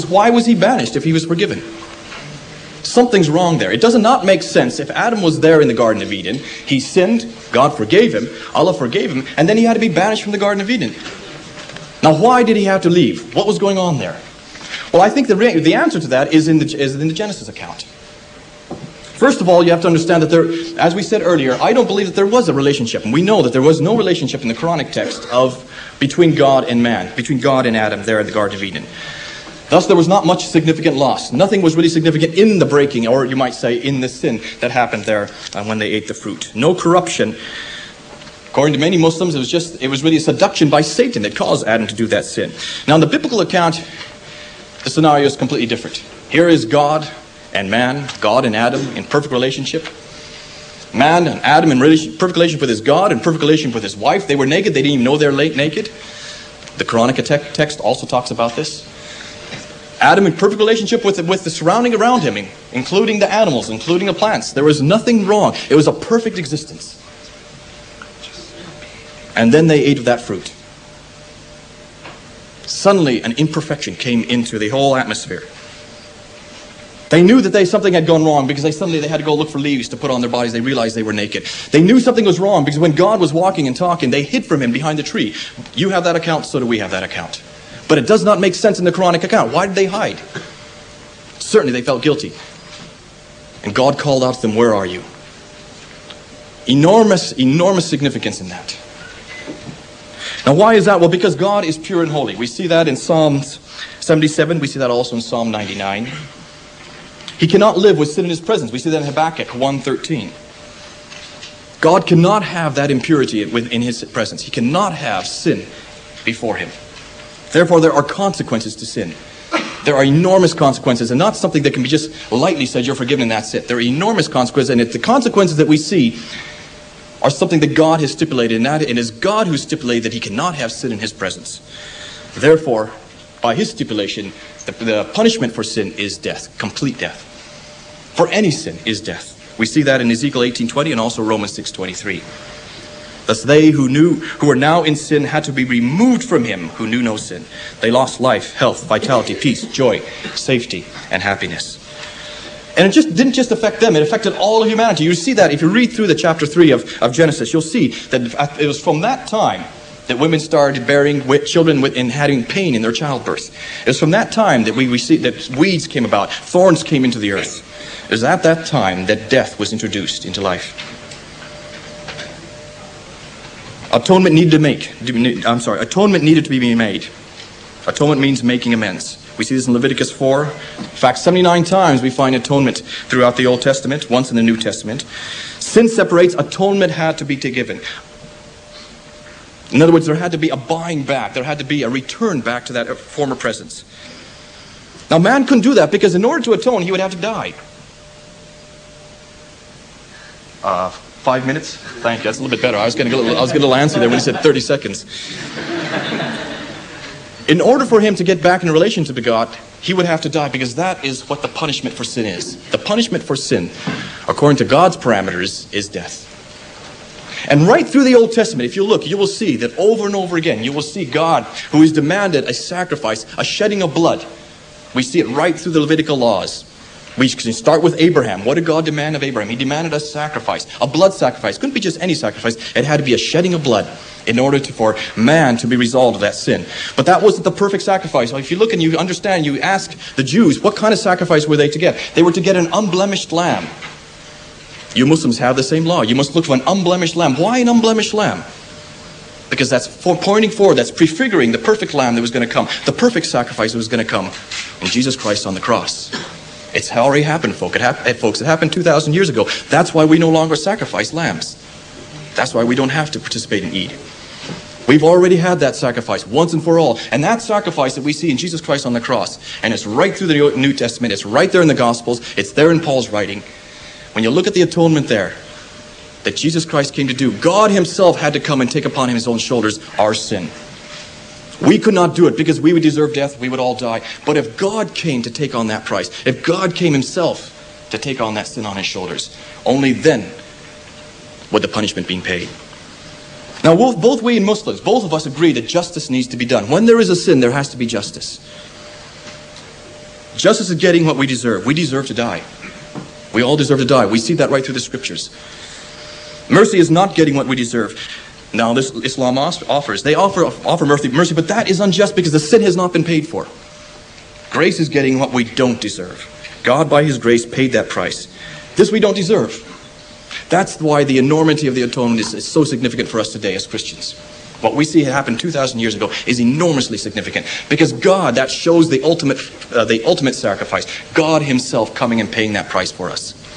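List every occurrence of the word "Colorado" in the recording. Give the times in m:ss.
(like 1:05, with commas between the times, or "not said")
not said.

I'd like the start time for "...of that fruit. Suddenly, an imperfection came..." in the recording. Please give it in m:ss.
1:09.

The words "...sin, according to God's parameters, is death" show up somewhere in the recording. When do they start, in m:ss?
3:33.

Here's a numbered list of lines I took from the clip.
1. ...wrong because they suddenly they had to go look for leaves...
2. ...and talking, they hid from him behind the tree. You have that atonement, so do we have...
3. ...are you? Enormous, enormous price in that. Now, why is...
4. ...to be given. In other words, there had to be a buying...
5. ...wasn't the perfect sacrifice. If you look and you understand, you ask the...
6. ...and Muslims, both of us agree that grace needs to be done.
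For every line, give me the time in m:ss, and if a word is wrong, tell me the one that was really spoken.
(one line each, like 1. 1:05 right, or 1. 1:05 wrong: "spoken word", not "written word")
1. 1:18 right
2. 1:23 wrong: "account", not "atonement"
3. 1:34 wrong: "significance", not "price"
4. 3:07 right
5. 3:57 right
6. 4:54 wrong: "justice", not "grace".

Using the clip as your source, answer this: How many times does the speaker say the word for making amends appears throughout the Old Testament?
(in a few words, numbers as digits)
79.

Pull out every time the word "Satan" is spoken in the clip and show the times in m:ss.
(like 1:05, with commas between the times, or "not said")
0:40.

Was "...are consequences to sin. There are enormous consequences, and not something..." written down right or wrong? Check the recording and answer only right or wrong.
right.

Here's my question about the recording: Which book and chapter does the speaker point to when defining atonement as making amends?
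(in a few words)
Leviticus 4.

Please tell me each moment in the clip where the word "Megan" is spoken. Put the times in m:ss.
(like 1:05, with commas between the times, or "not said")
not said.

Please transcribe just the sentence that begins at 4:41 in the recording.
We could not do it because we would deserve death, we would all die.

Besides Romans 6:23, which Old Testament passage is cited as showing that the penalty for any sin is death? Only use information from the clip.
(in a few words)
Ezekiel 18:20.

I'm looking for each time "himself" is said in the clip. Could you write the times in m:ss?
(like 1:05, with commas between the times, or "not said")
4:37, 4:46, 5:31.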